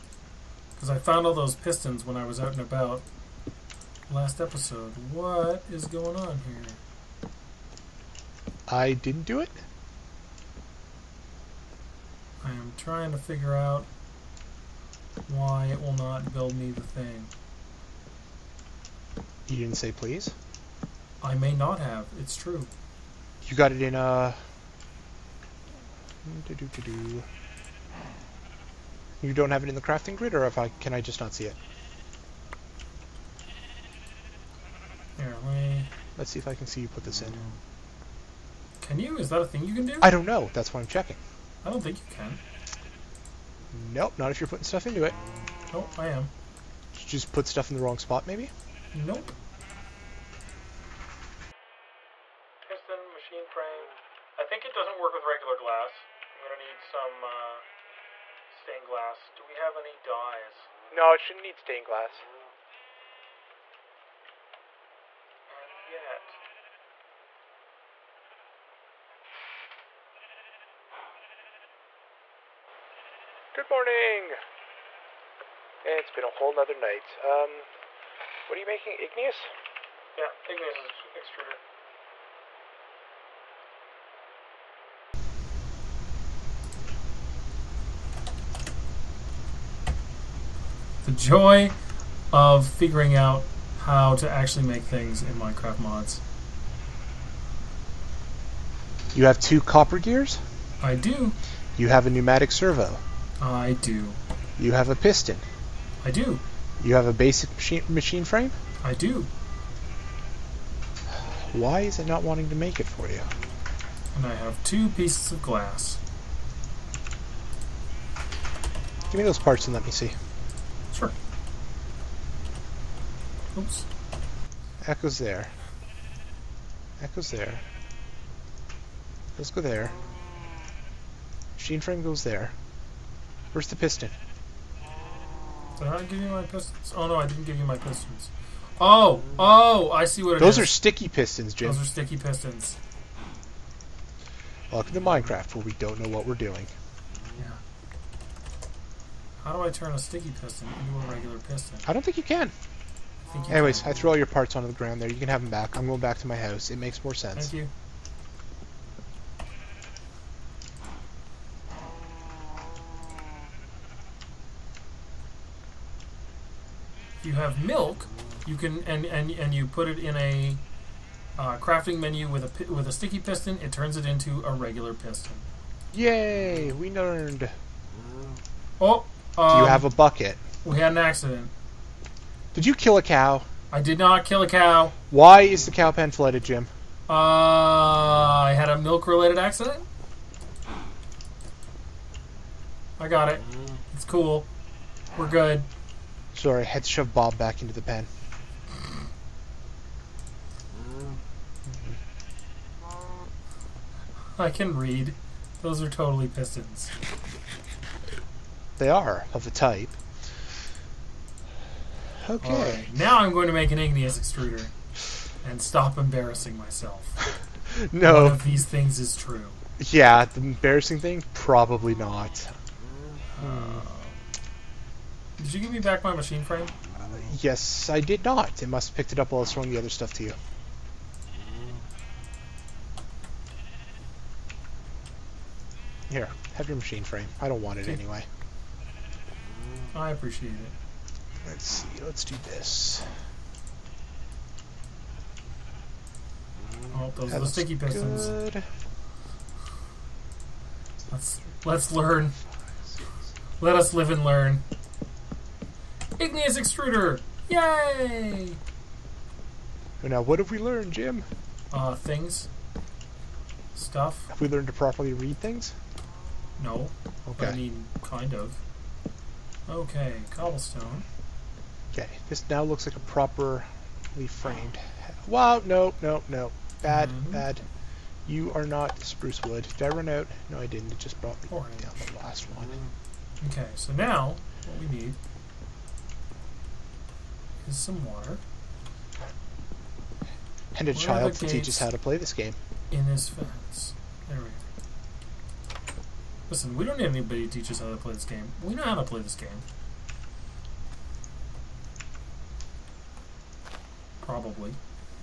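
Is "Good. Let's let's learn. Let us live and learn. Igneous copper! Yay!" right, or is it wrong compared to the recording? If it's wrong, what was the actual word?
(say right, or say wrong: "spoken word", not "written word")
wrong: "extruder", not "copper".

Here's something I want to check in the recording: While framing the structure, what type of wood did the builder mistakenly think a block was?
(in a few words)
Spruce.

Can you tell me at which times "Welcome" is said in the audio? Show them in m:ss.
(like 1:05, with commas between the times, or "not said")
2:24.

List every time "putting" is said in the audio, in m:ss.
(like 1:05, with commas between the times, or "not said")
0:44.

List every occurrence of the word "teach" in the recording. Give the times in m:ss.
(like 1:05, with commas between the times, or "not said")
4:51, 4:57.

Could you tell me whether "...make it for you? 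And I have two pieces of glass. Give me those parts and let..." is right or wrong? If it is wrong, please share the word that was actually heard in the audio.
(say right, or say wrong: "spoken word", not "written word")
right.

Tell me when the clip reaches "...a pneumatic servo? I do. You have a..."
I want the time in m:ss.
1:42.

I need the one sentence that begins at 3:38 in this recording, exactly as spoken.
One of these things is true.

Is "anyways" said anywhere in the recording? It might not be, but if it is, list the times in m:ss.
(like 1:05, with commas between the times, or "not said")
2:33, 3:57.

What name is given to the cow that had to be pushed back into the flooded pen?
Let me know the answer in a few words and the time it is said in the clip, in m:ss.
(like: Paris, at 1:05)
Bob, at 3:17.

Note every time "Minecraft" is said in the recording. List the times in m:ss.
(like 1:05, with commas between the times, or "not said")
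1:35, 2:25.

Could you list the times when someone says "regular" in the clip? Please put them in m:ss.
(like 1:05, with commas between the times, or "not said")
0:55, 2:31, 2:54.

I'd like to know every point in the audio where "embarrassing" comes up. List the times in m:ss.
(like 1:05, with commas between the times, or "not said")
3:35, 3:40.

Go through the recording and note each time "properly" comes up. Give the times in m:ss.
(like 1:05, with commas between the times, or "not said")
4:24, 4:33.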